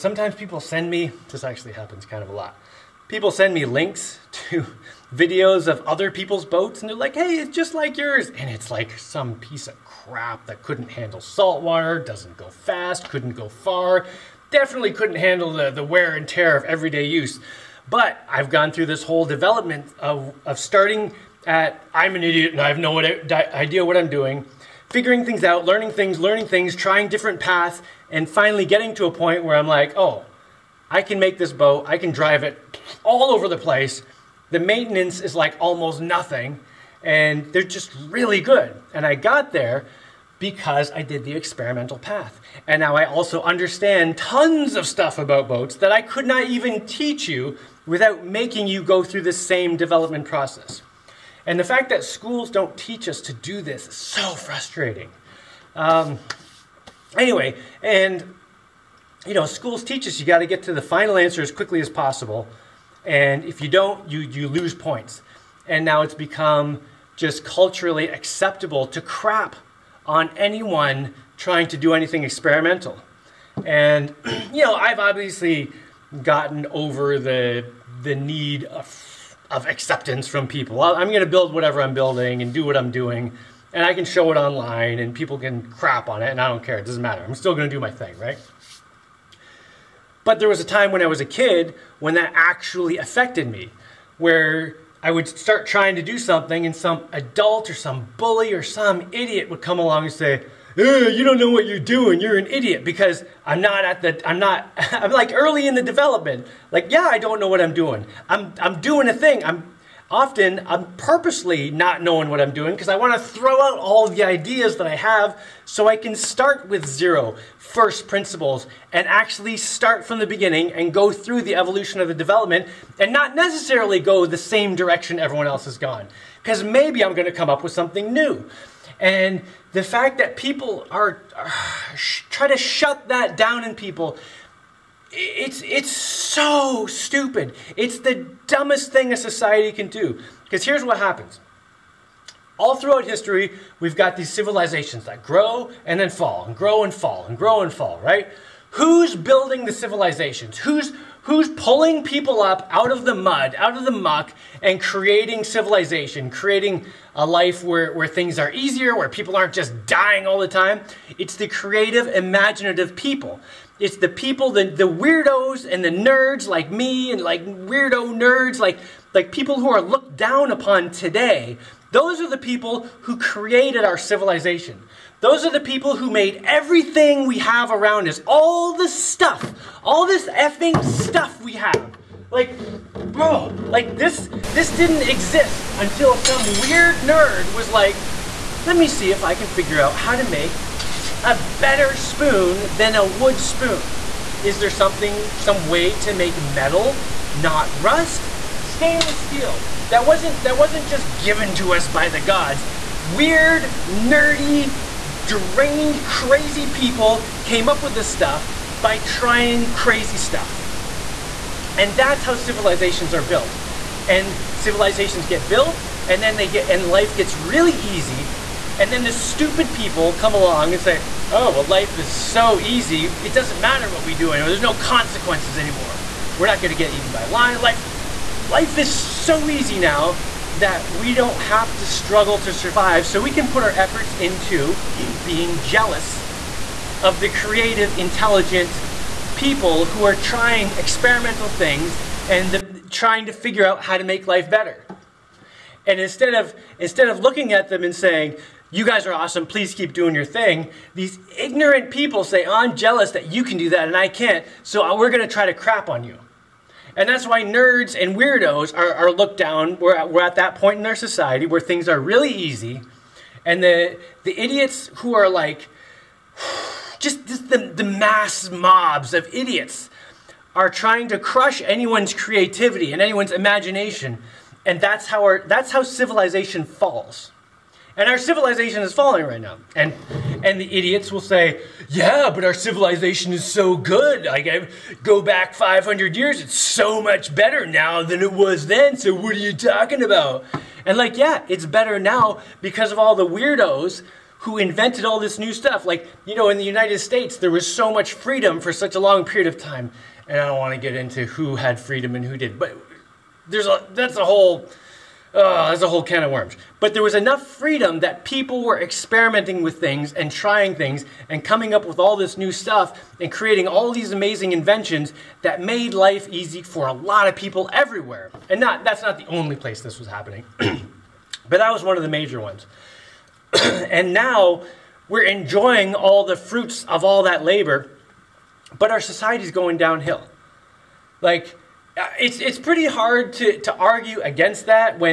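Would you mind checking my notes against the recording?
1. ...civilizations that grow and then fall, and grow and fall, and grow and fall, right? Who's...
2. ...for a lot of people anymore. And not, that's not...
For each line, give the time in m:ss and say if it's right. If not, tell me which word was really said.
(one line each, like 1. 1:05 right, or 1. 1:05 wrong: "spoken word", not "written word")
1. 2:24 right
2. 5:16 wrong: "everywhere", not "anymore".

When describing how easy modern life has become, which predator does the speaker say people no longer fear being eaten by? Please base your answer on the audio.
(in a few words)
lion.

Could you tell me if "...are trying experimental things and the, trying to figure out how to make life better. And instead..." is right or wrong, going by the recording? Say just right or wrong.
right.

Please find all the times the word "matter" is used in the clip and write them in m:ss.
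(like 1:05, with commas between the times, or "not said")
1:27, 3:43.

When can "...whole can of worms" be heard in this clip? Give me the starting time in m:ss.
5:05.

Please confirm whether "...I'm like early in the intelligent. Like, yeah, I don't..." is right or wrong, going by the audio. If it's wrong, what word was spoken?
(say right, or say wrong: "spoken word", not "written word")
wrong: "development", not "intelligent".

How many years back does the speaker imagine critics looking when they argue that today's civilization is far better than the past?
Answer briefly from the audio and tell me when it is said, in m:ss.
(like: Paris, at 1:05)
500, at 4:45.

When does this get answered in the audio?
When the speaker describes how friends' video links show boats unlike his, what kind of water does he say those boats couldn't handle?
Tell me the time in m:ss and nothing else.
0:11.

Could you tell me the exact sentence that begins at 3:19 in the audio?
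That wasn't, that wasn't just given to us by the gods.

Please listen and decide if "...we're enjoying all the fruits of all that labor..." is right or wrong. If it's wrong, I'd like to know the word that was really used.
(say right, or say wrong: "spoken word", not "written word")
right.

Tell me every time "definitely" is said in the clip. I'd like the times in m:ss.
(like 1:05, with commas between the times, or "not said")
0:14.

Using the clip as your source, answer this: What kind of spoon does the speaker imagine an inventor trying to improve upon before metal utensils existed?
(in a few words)
wood spoon.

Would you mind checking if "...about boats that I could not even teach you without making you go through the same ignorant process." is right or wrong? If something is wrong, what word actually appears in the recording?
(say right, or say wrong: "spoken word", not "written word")
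wrong: "development", not "ignorant".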